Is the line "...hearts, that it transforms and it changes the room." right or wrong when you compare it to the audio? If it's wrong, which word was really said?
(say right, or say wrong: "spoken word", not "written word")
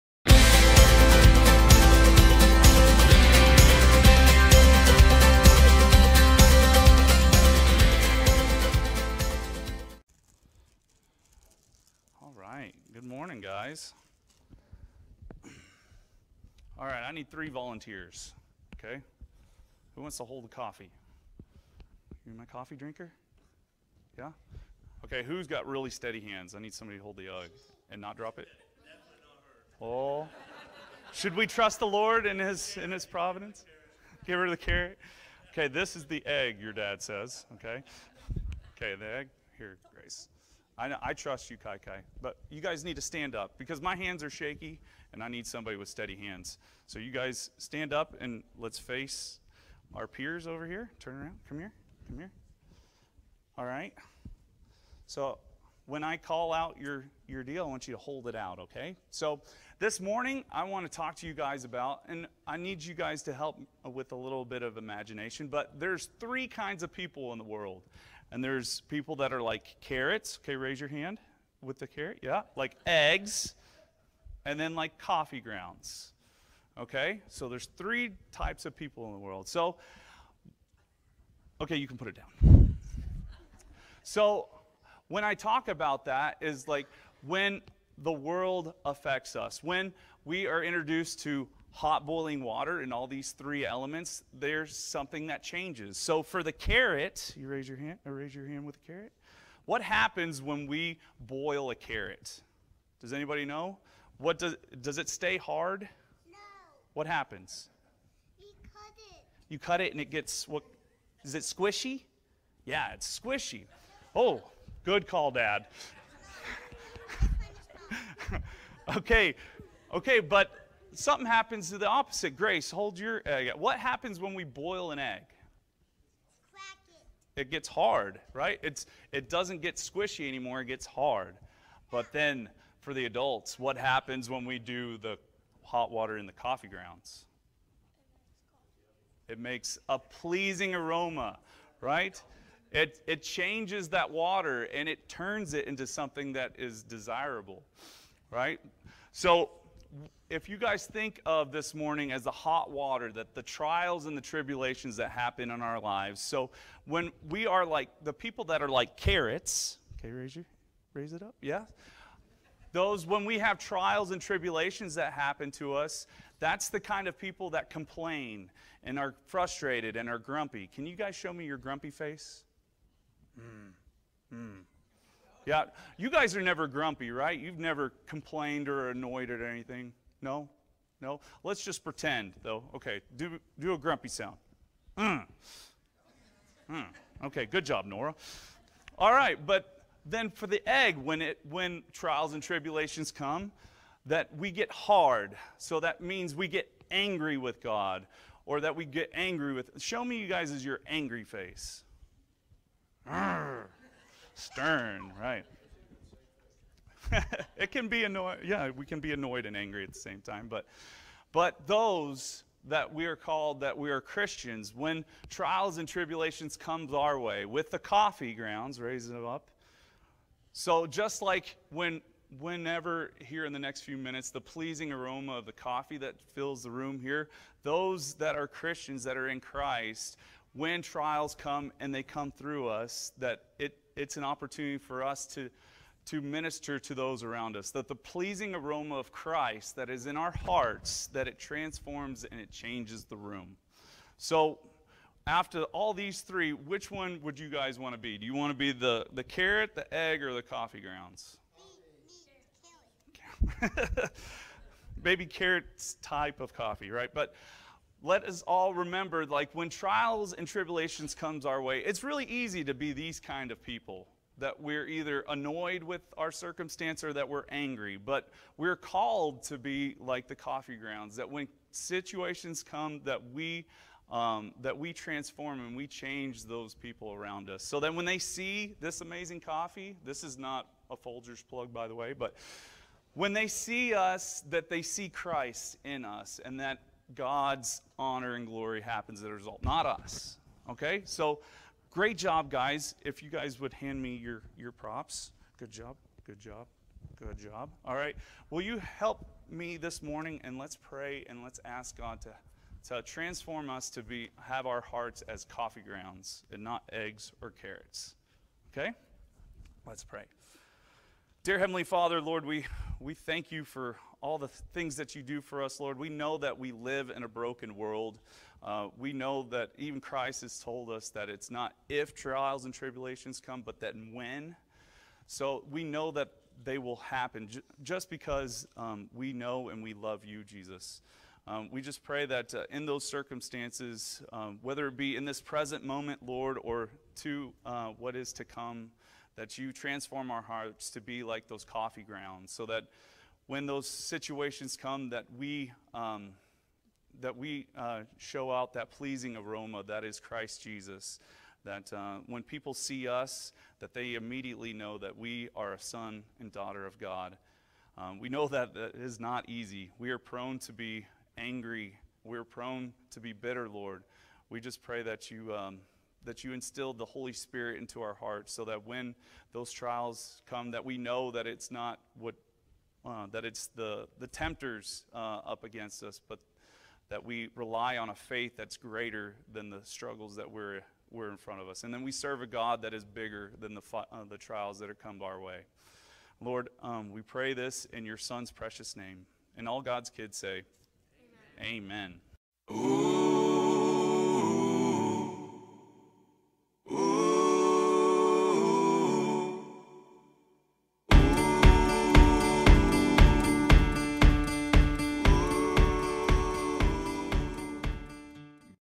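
right.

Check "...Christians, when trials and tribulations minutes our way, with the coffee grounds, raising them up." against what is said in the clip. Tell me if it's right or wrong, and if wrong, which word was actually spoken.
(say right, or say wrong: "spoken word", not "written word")
wrong: "comes", not "minutes".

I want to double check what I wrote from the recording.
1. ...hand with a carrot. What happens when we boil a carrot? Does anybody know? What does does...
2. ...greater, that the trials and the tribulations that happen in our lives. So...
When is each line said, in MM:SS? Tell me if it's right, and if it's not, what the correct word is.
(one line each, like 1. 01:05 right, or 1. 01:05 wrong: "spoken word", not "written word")
1. 01:38 right
2. 02:32 wrong: "water", not "greater".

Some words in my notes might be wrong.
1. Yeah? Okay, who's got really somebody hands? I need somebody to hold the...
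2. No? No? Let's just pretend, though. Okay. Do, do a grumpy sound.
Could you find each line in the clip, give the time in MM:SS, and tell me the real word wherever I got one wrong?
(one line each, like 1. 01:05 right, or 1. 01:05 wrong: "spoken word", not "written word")
1. 00:24 wrong: "steady", not "somebody"
2. 03:00 right.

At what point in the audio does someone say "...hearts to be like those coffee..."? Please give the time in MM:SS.
05:40.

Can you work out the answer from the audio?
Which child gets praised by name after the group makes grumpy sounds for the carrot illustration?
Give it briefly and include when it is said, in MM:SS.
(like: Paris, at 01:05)
Nora, at 03:07.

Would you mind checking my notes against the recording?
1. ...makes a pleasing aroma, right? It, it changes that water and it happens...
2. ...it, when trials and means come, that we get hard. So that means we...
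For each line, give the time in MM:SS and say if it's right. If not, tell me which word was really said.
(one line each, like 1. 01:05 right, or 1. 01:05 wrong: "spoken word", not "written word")
1. 02:19 wrong: "turns", not "happens"
2. 03:11 wrong: "tribulations", not "means".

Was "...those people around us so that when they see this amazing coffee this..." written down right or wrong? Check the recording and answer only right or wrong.
right.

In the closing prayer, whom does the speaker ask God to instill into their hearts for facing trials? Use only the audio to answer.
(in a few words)
The Holy Spirit.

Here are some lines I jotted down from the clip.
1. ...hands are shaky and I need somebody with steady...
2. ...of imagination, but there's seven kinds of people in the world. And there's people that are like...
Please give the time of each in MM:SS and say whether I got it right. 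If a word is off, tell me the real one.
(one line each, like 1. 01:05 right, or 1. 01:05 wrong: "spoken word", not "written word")
1. 00:43 right
2. 01:04 wrong: "three", not "seven".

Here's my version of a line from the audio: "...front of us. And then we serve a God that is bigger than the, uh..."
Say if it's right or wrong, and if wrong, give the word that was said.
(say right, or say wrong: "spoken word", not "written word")
right.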